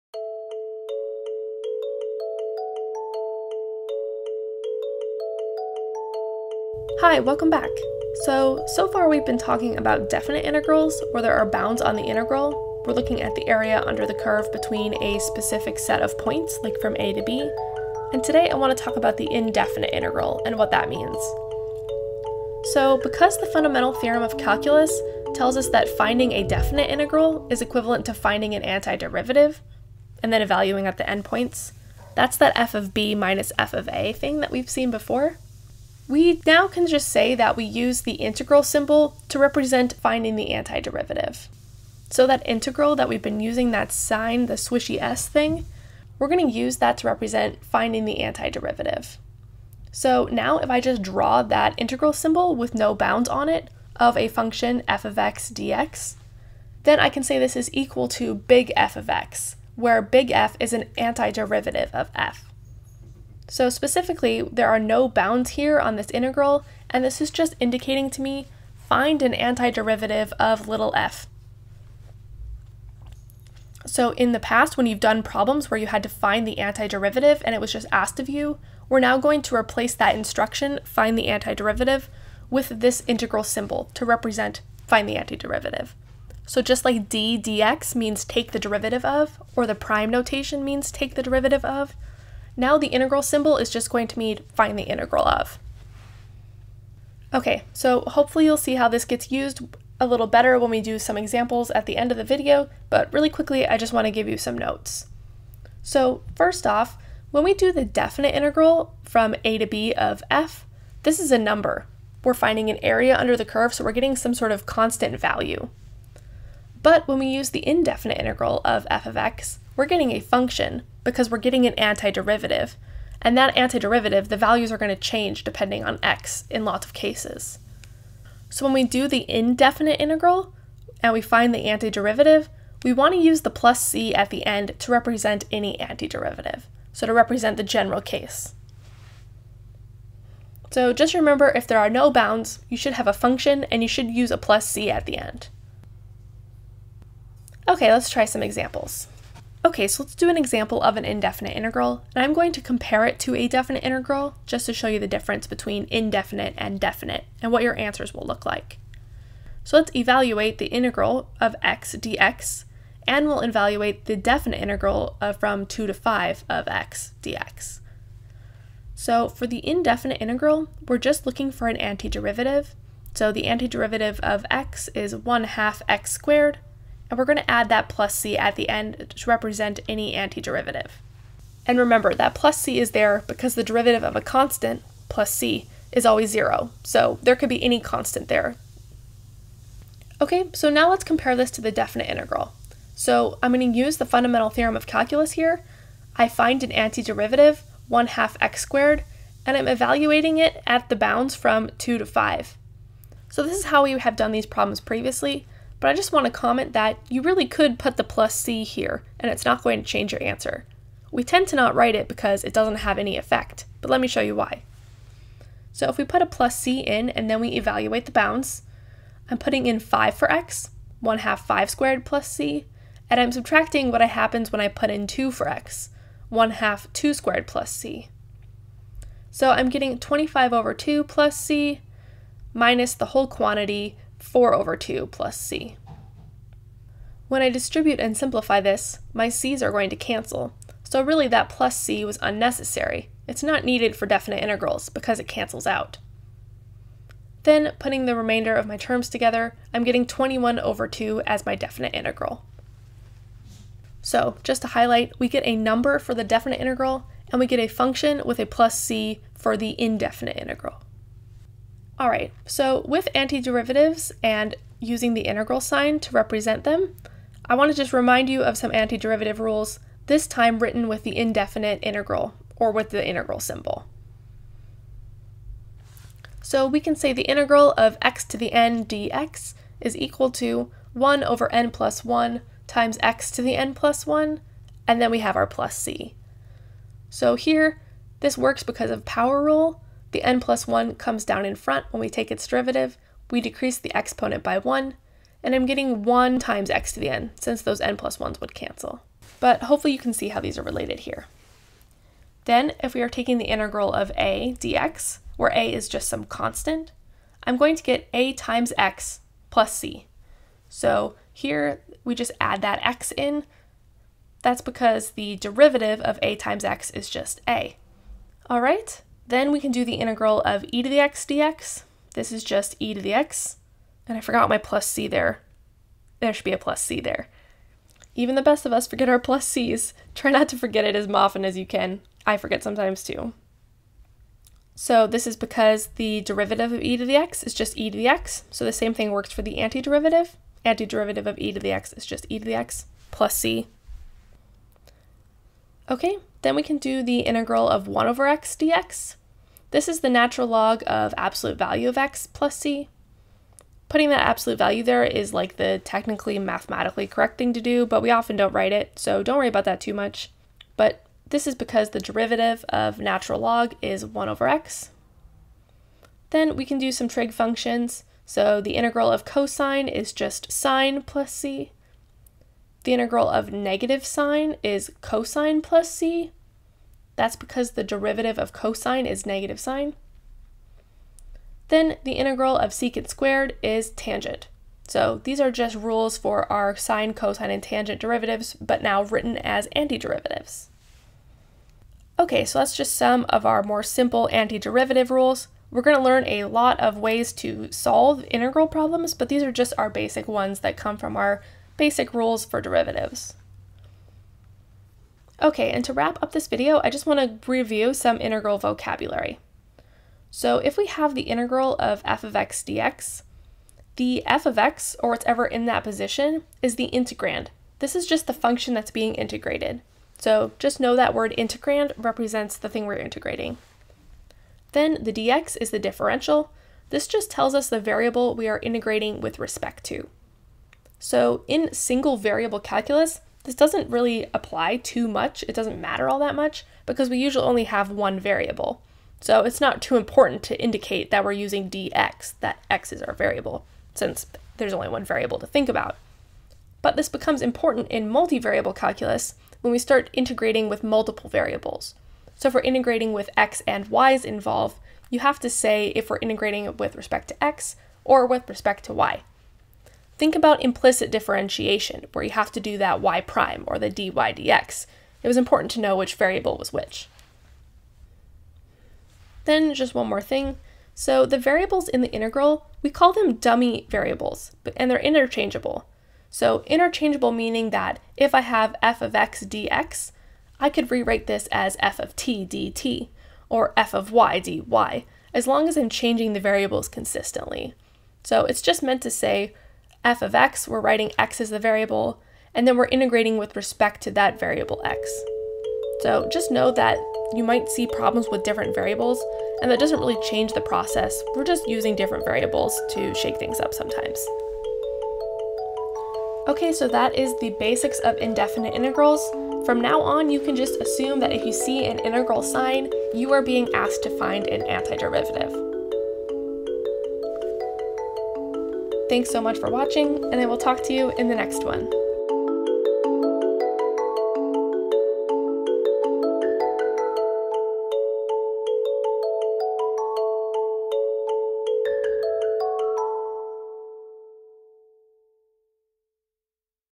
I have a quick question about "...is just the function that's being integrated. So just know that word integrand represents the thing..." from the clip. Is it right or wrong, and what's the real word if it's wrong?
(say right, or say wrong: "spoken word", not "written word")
right.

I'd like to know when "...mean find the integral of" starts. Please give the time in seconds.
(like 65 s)
94 s.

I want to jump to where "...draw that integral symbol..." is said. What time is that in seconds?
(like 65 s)
51 s.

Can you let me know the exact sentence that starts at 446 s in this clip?
But this becomes important in multivariable calculus when we start integrating with multiple variables.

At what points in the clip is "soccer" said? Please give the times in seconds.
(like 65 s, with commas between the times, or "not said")
not said.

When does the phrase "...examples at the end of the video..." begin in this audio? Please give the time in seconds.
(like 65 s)
101 s.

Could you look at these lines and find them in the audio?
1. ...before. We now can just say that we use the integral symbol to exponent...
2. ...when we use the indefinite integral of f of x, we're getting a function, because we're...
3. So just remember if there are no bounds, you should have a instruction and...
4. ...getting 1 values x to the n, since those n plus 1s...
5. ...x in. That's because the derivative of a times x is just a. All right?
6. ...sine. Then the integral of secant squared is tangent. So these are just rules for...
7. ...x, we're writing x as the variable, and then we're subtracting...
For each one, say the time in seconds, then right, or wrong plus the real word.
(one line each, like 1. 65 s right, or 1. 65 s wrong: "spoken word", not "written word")
1. 34 s wrong: "represent", not "exponent"
2. 117 s right
3. 140 s wrong: "function", not "instruction"
4. 295 s wrong: "times", not "values"
5. 312 s right
6. 379 s right
7. 490 s wrong: "integrating", not "subtracting".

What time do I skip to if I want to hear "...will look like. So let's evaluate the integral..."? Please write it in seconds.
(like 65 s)
158 s.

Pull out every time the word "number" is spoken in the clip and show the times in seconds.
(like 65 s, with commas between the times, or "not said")
111 s, 255 s.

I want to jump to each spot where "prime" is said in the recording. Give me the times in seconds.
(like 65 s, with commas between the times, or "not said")
89 s, 463 s.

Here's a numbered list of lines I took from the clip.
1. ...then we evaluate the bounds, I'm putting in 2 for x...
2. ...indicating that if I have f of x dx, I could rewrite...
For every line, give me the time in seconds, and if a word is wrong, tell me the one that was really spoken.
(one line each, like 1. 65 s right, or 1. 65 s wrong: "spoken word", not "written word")
1. 217 s wrong: "5", not "2"
2. 477 s wrong: "meaning", not "indicating".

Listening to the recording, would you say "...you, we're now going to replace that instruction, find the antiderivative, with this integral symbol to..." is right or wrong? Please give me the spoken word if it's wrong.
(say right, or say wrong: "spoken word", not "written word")
right.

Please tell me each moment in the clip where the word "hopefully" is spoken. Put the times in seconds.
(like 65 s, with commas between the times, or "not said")
98 s, 299 s.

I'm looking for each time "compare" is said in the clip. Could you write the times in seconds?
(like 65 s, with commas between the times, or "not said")
152 s, 191 s.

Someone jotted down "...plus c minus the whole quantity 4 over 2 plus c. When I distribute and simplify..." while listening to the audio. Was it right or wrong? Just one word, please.
right.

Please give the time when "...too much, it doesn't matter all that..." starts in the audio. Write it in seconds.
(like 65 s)
434 s.